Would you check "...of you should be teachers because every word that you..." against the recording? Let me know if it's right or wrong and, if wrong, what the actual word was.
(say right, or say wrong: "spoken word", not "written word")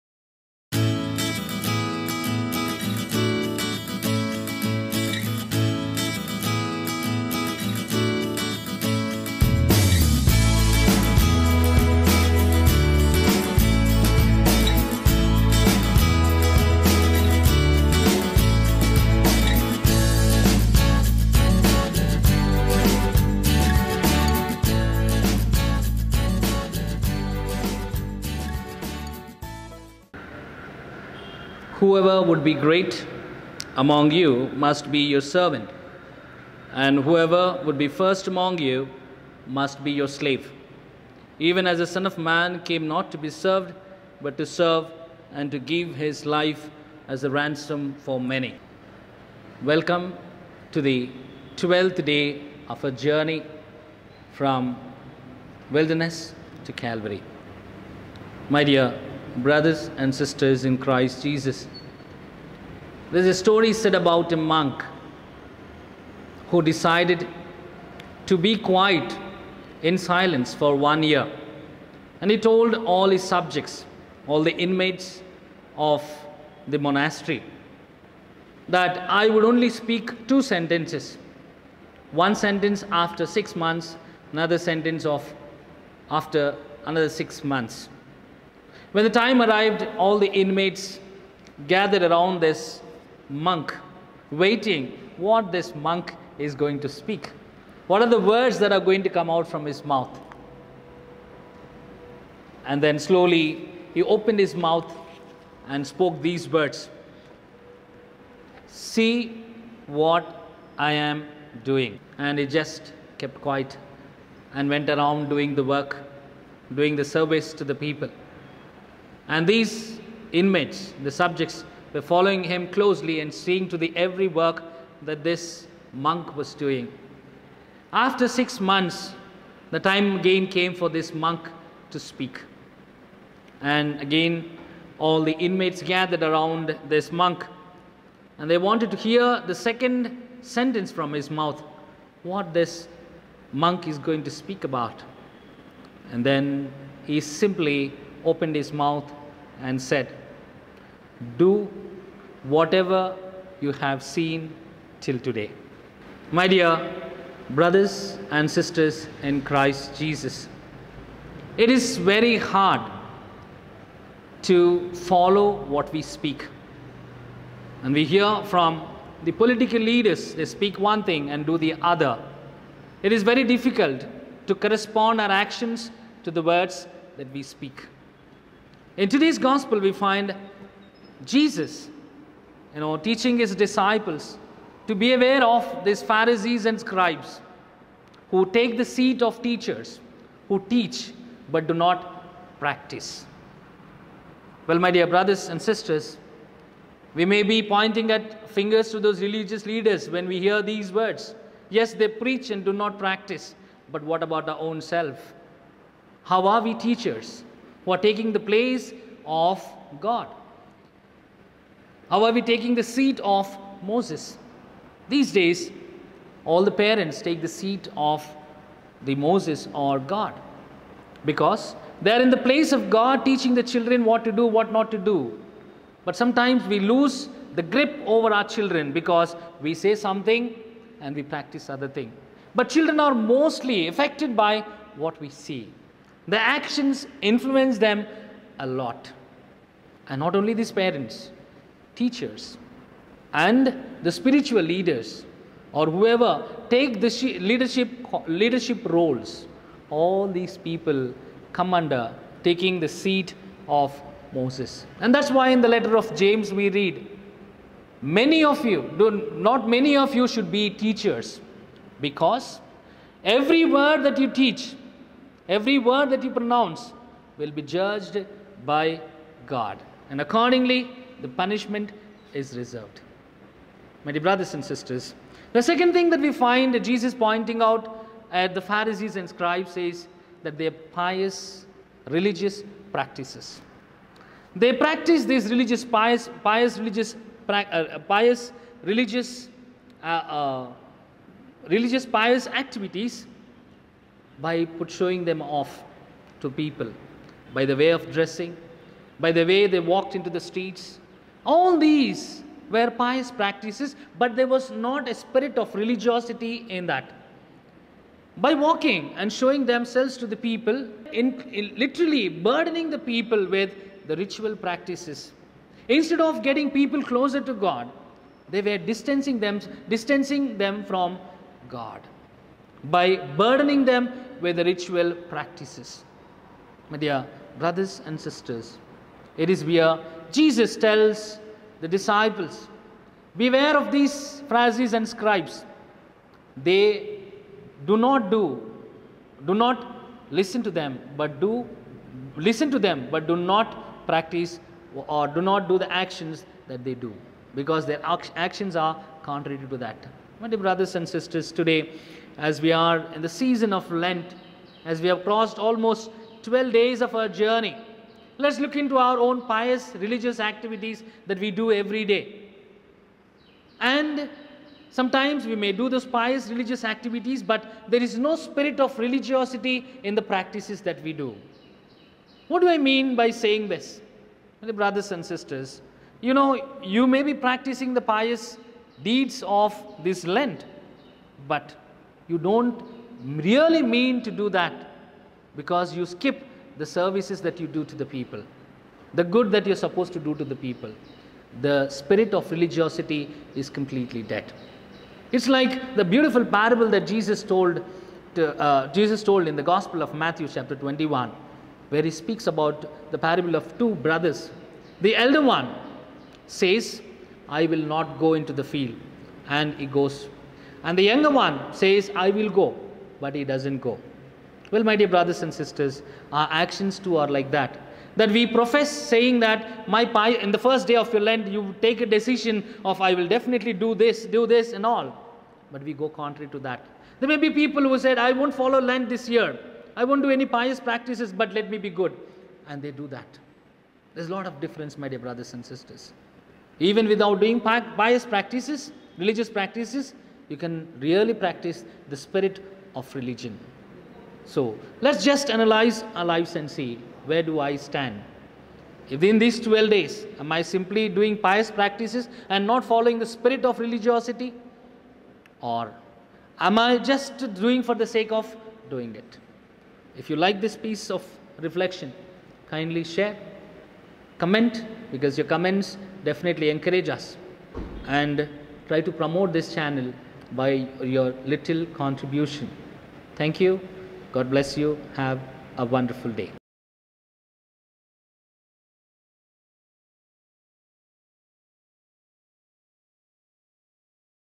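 right.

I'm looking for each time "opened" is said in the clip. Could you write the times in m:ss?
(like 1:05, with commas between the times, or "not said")
1:44, 2:28.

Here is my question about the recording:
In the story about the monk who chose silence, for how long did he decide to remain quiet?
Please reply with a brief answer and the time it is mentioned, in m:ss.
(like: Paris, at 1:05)
1 year, at 1:10.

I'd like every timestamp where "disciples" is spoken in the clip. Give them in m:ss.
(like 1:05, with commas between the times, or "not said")
3:03, 5:31.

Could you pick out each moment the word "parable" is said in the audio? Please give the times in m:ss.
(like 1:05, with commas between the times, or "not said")
6:36, 6:43.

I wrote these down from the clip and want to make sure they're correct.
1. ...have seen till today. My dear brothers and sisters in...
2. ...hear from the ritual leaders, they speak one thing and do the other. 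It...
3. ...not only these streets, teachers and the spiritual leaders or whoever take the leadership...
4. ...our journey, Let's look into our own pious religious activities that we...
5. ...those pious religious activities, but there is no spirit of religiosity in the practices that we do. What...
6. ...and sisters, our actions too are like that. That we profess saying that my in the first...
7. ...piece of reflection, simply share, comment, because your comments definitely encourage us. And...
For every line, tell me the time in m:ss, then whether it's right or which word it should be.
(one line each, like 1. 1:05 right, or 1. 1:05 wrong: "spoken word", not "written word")
1. 2:33 right
2. 2:48 wrong: "political", not "ritual"
3. 4:00 wrong: "parents", not "streets"
4. 5:57 right
5. 6:05 right
6. 6:55 right
7. 7:40 wrong: "kindly", not "simply".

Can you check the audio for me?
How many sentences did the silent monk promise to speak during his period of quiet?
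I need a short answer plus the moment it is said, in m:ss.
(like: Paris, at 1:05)
2, at 1:20.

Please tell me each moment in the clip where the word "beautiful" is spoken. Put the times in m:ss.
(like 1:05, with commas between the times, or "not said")
6:36.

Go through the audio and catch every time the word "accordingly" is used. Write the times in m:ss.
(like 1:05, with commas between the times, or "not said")
4:30.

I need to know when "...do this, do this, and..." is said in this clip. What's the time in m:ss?
7:03.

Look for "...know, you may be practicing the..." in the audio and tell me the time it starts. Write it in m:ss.
6:16.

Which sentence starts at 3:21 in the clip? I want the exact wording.
Yes, they preach and do not practice, but what about our own self?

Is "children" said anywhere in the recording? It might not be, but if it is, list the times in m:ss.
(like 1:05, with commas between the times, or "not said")
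3:43, 3:48, 3:52.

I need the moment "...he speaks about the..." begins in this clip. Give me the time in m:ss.
6:42.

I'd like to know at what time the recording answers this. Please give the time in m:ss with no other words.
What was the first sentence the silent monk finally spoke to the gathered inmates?
1:48.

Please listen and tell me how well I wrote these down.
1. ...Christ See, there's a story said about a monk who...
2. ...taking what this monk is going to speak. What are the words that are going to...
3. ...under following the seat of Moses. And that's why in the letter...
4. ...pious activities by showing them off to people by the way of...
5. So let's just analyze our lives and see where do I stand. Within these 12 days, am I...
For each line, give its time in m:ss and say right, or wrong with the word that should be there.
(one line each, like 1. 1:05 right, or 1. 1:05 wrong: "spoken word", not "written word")
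1. 1:00 wrong: "Jesus", not "See"
2. 1:34 wrong: "waiting", not "taking"
3. 4:11 wrong: "taking", not "following"
4. 4:52 right
5. 7:24 right.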